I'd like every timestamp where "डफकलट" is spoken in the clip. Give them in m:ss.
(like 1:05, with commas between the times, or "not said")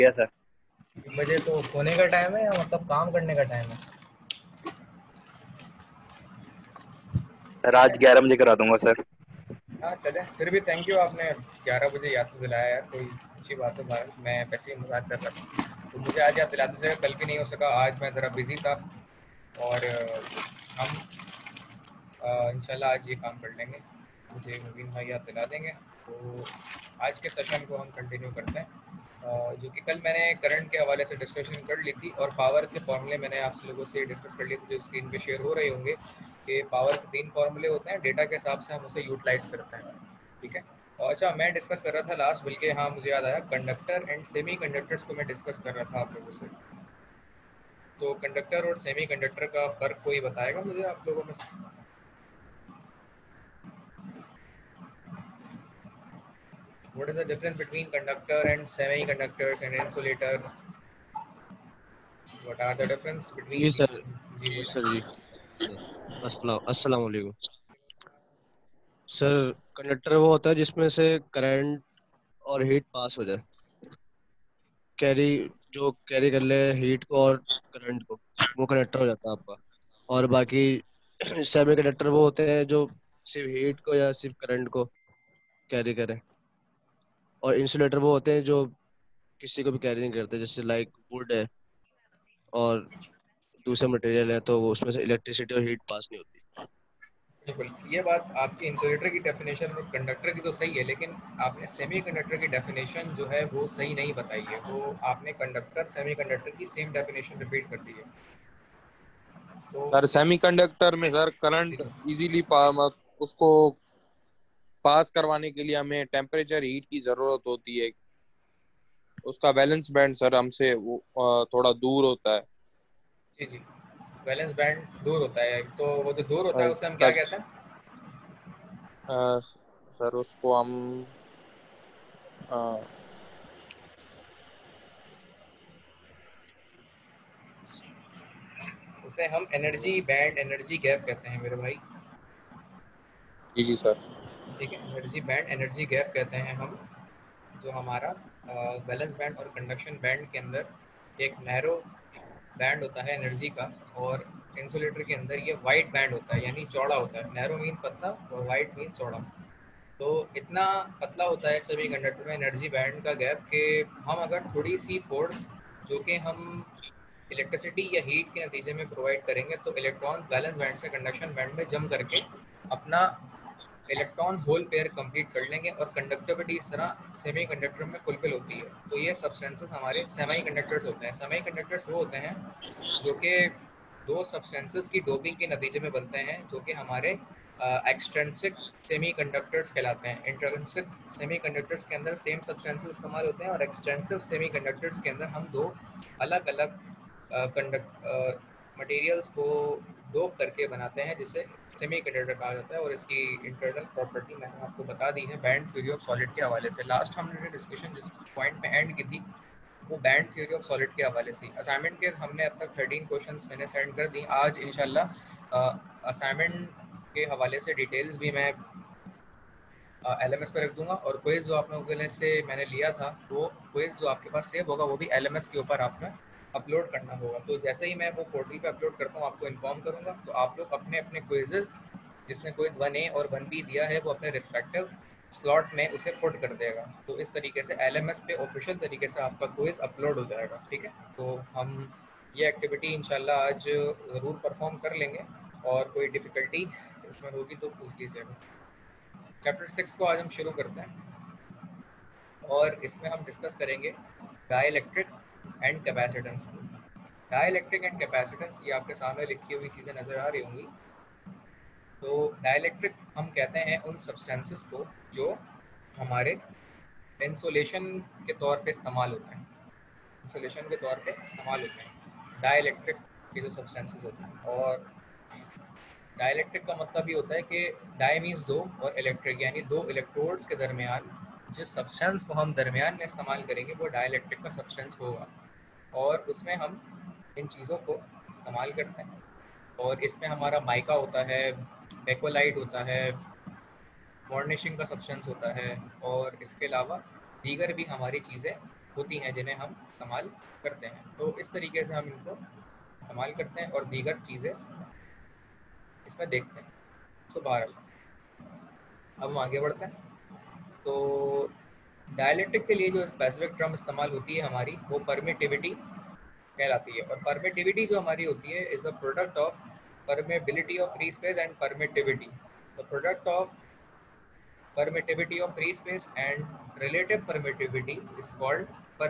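4:06.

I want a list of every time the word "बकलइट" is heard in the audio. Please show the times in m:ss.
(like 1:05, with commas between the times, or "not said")
4:52.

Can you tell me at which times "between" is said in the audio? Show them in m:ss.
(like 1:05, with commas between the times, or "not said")
0:57, 1:03.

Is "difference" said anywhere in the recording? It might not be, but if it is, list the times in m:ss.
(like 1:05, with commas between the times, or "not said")
0:57, 1:02.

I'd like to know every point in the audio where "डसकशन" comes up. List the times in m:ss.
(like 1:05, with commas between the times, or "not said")
0:31, 3:27.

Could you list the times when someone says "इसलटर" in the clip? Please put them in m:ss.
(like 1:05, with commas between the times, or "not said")
1:27, 1:38, 2:34.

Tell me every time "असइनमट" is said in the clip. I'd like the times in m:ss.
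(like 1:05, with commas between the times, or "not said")
3:31, 3:36.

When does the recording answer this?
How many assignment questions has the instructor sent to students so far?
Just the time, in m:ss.
3:32.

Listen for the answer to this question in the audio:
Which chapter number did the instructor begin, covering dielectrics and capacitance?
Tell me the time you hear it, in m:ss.
4:09.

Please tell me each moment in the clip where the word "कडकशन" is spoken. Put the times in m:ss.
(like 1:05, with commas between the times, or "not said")
2:29, 2:50.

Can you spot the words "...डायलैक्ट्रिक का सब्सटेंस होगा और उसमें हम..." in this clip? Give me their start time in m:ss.
4:43.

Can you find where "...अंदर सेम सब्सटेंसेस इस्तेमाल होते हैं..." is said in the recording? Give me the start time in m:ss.
3:11.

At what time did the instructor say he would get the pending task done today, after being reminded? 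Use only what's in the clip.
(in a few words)
11 o'clock.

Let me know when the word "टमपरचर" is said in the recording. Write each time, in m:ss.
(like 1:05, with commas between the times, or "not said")
1:56.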